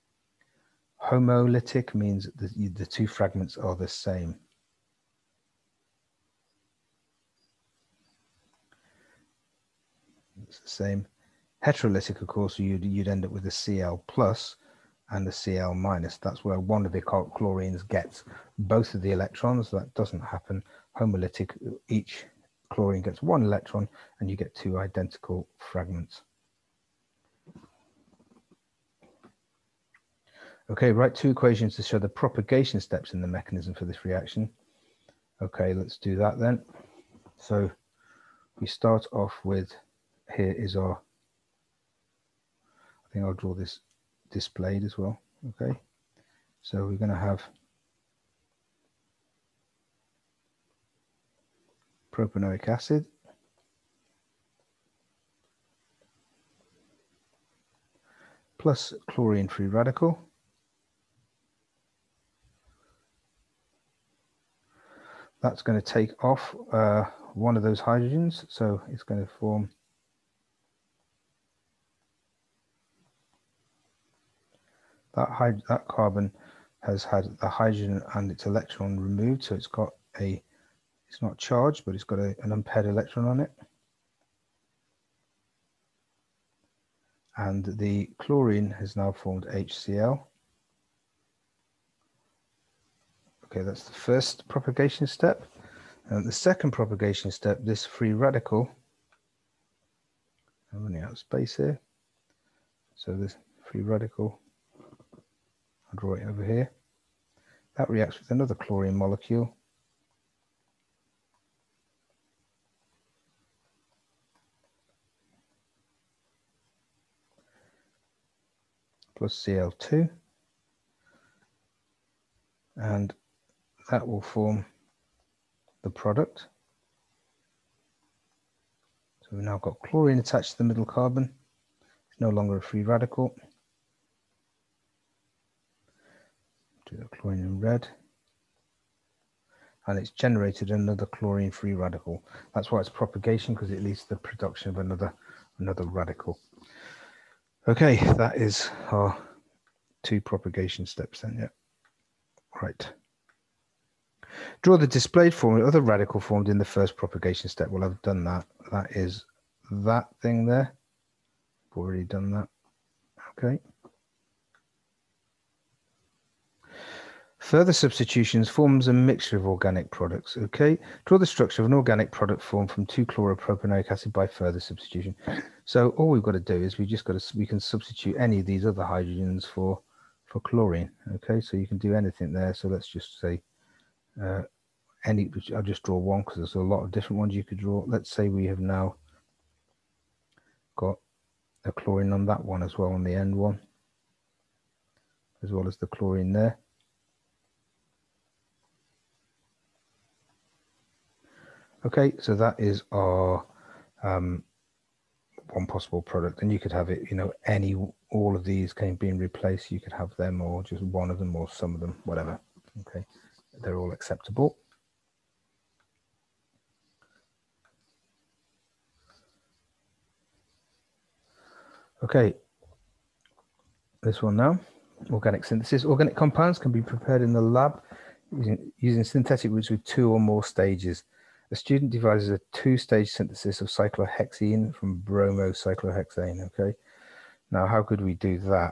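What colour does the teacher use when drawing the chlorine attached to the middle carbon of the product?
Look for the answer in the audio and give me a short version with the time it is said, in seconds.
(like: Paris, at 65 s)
Red, at 137 s.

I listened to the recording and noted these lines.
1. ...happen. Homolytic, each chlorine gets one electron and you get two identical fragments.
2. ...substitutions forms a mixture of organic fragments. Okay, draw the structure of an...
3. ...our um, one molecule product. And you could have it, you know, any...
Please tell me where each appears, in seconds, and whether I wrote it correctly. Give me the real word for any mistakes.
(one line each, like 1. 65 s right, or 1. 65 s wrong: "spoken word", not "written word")
1. 20 s right
2. 167 s wrong: "products", not "fragments"
3. 202 s wrong: "possible", not "molecule".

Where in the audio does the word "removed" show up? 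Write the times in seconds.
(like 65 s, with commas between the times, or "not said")
78 s.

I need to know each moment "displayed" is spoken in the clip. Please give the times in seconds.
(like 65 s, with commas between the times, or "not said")
44 s, 154 s.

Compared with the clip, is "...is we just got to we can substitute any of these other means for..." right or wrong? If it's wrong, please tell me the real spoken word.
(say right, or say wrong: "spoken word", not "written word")
wrong: "hydrogens", not "means".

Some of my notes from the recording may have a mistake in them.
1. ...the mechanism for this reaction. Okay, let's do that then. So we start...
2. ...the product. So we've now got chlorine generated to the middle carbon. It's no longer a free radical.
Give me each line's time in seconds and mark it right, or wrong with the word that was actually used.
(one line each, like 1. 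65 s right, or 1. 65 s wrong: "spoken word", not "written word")
1. 33 s right
2. 125 s wrong: "attached", not "generated".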